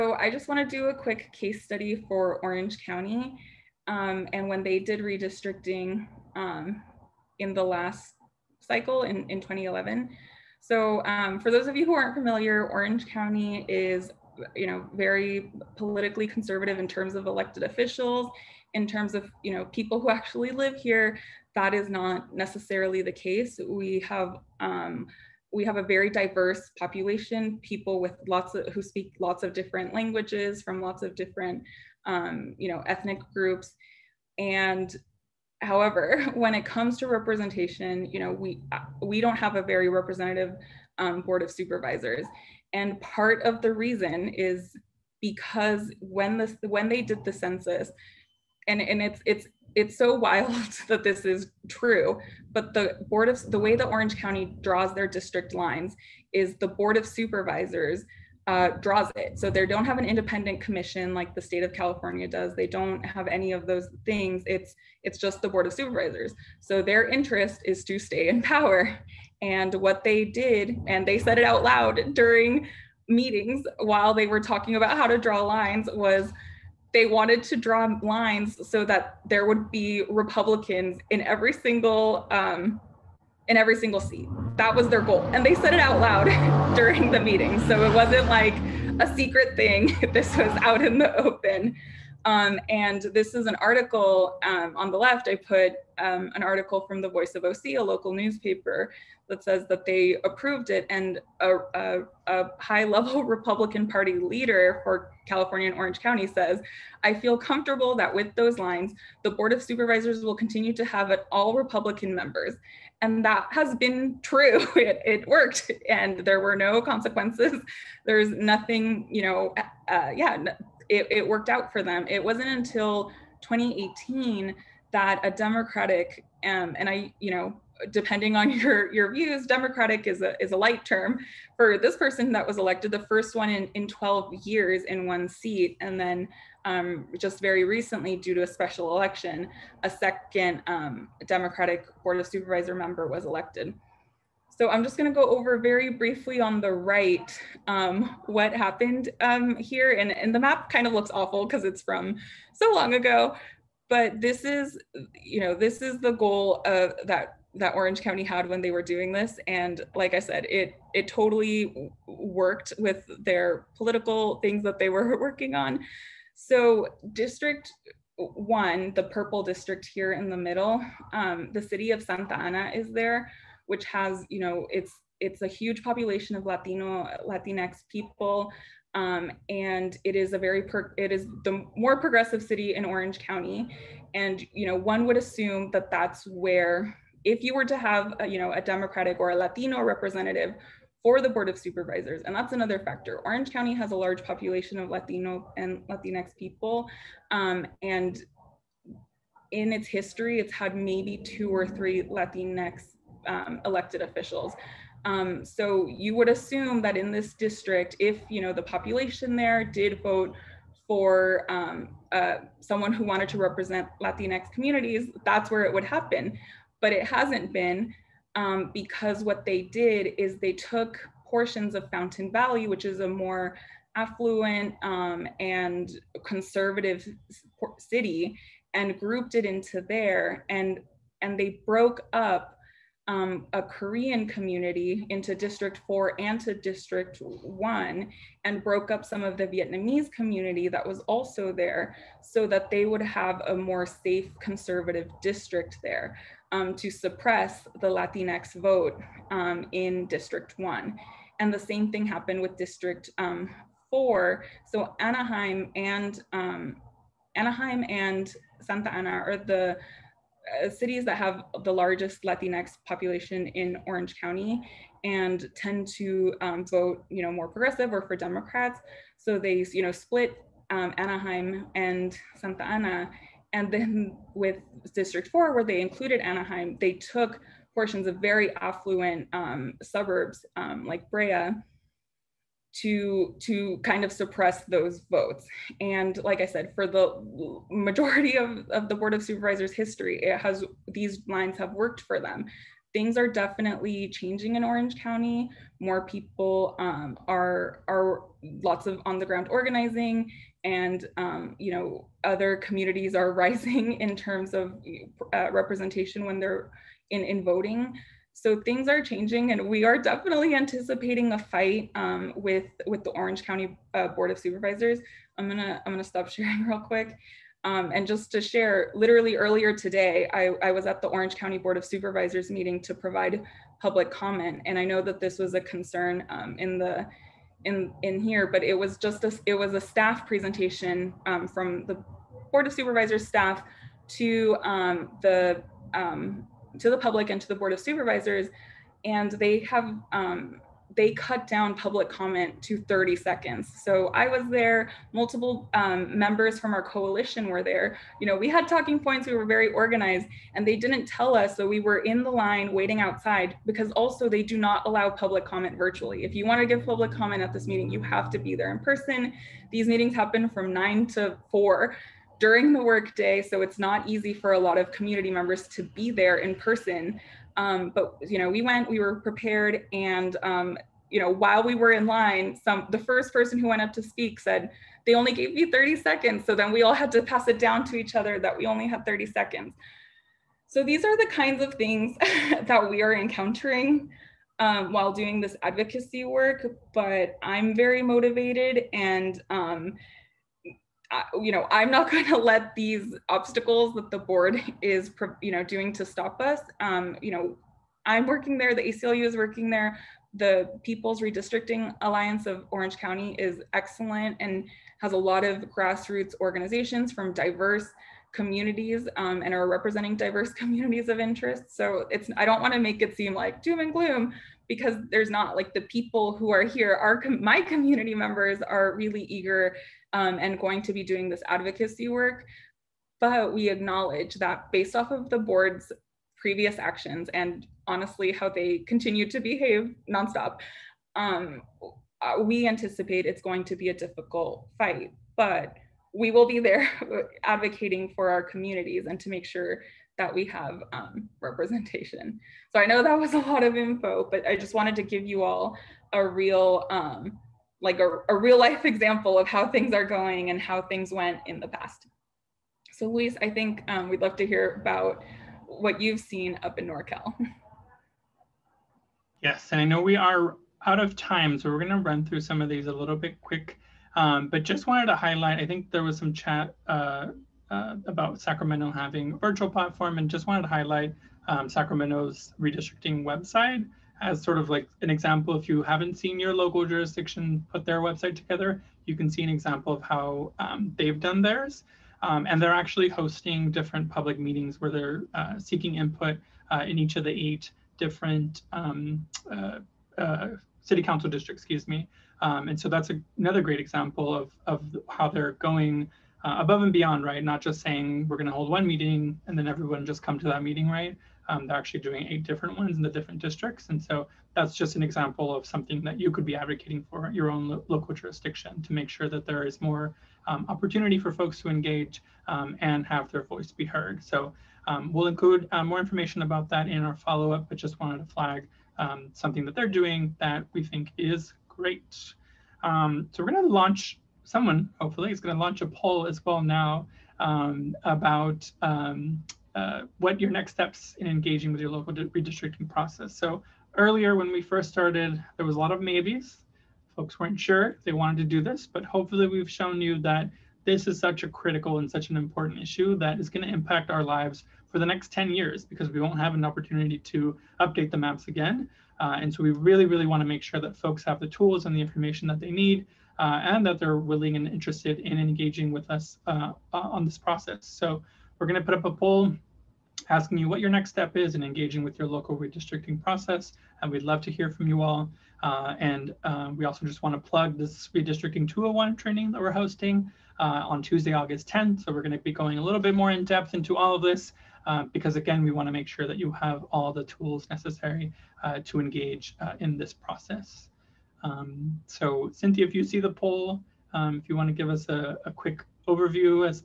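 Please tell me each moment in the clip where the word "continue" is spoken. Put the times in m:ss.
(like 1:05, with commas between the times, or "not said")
1:50, 7:08.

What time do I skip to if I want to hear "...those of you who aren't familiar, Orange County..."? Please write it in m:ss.
0:11.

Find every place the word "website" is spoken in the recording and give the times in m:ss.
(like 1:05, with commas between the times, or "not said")
7:53, 7:58.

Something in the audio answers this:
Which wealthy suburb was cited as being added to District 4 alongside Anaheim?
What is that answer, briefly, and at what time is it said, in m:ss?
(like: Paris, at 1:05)
Brea, at 4:41.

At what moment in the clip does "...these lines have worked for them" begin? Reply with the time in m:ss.
4:50.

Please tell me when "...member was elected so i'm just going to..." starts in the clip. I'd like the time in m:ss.
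2:22.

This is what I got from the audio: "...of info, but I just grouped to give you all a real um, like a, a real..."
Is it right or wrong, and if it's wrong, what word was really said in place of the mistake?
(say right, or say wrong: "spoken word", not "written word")
wrong: "wanted", not "grouped".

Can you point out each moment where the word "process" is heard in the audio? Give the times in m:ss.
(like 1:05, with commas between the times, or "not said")
8:52, 9:17, 9:23, 9:40.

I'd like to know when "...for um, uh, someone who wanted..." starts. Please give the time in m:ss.
3:30.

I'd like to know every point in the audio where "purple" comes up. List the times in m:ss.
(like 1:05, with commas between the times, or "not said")
2:49.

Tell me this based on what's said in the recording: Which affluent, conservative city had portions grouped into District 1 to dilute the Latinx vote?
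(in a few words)
Fountain Valley.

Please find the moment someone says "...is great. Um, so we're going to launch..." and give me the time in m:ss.
8:41.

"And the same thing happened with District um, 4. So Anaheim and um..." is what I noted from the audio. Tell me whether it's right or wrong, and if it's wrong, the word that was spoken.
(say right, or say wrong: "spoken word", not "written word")
right.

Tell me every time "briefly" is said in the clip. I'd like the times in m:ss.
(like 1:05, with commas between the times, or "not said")
2:25.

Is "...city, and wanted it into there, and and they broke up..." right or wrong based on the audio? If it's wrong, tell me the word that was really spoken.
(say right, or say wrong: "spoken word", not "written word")
wrong: "grouped", not "wanted".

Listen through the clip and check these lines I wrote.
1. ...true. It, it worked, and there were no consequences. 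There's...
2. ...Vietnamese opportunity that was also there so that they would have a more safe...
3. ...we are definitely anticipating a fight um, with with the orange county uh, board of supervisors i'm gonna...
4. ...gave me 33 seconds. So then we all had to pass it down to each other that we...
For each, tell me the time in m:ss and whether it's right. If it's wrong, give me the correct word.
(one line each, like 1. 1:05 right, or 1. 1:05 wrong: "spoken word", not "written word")
1. 1:54 right
2. 3:59 wrong: "community", not "opportunity"
3. 5:09 right
4. 6:15 wrong: "30", not "33".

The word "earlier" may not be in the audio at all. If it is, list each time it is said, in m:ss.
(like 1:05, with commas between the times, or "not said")
5:19, 8:53.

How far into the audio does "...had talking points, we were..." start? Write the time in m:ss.
5:48.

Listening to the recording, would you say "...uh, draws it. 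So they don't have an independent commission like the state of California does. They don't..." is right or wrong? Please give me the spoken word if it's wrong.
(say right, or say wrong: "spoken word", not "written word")
right.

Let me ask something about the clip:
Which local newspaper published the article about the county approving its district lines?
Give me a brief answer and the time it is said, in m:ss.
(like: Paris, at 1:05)
Voice of OC, at 1:37.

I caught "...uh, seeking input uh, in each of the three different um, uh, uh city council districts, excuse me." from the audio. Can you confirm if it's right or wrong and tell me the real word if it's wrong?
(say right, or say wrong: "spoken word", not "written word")
wrong: "eight", not "three".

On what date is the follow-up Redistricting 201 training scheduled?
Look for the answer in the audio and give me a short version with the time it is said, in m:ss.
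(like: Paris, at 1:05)
Tuesday, August 10, at 9:31.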